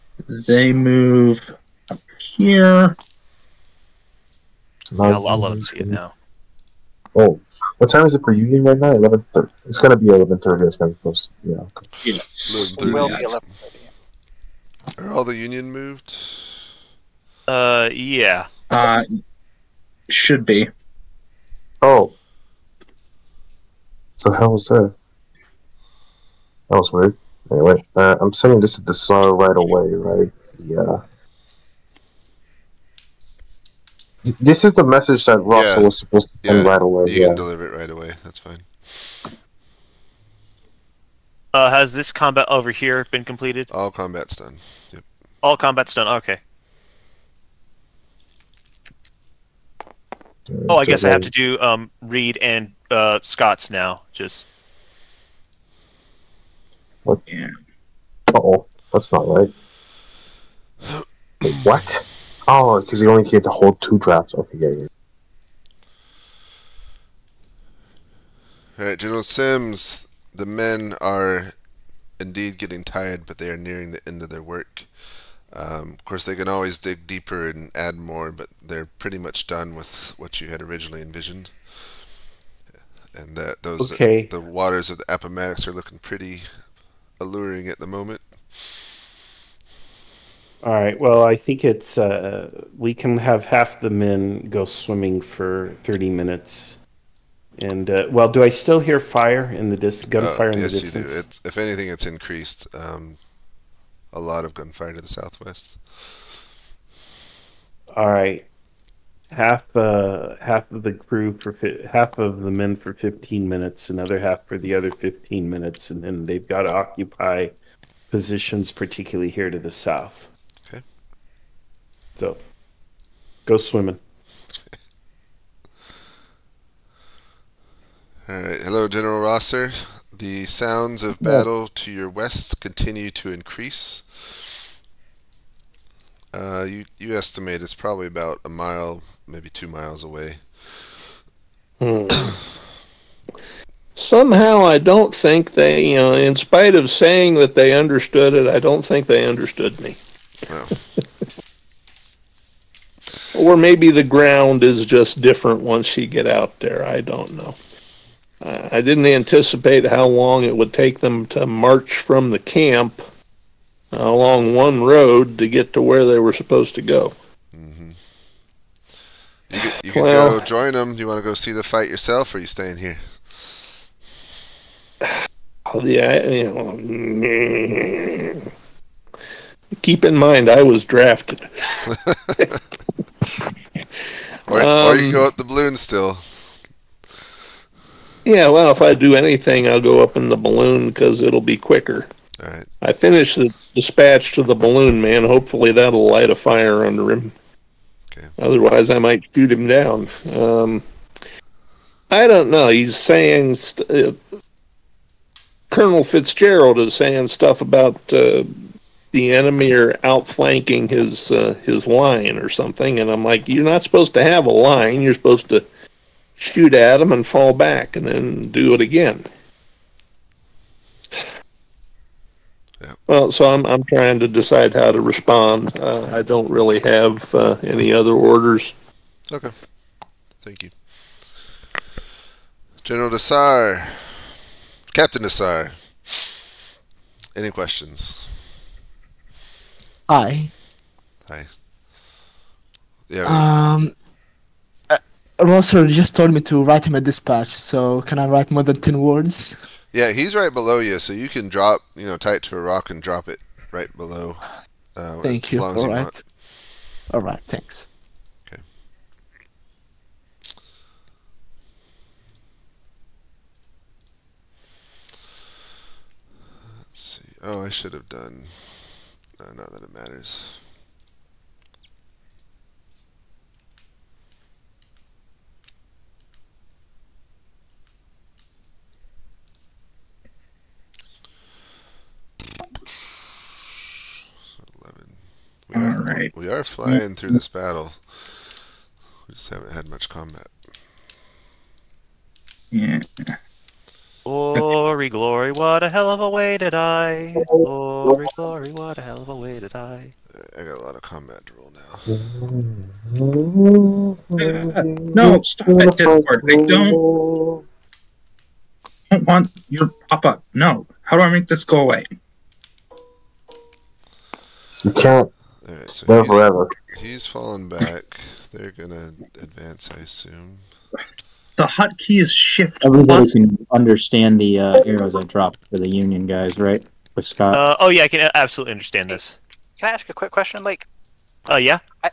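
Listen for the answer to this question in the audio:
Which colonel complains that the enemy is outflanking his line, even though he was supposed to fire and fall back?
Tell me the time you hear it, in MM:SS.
03:25.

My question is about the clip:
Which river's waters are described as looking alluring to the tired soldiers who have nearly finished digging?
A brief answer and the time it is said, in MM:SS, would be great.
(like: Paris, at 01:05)
Appomattox, at 01:25.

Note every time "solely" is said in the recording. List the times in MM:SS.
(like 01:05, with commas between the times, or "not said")
not said.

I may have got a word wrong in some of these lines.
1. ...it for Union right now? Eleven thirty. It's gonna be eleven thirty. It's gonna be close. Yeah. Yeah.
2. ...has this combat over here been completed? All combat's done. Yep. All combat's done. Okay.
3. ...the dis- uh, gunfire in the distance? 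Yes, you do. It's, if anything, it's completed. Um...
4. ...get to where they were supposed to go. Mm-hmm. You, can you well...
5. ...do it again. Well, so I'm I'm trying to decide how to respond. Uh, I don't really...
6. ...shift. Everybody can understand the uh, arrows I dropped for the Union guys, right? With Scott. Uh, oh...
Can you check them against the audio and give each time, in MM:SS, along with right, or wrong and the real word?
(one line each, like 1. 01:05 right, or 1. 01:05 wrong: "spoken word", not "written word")
1. 00:08 right
2. 00:41 right
3. 01:39 wrong: "increased", not "completed"
4. 02:45 right
5. 03:38 right
6. 05:22 right.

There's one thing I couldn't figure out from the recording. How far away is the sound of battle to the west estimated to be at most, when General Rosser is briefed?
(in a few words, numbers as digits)
2 miles.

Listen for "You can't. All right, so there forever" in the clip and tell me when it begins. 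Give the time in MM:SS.
05:14.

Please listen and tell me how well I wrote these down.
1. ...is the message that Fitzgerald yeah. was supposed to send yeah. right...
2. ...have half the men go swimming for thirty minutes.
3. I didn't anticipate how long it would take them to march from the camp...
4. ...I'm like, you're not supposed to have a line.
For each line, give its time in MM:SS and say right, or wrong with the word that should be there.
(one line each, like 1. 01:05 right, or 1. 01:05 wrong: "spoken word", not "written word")
1. 00:34 wrong: "Russell", not "Fitzgerald"
2. 01:33 right
3. 02:38 right
4. 03:33 right.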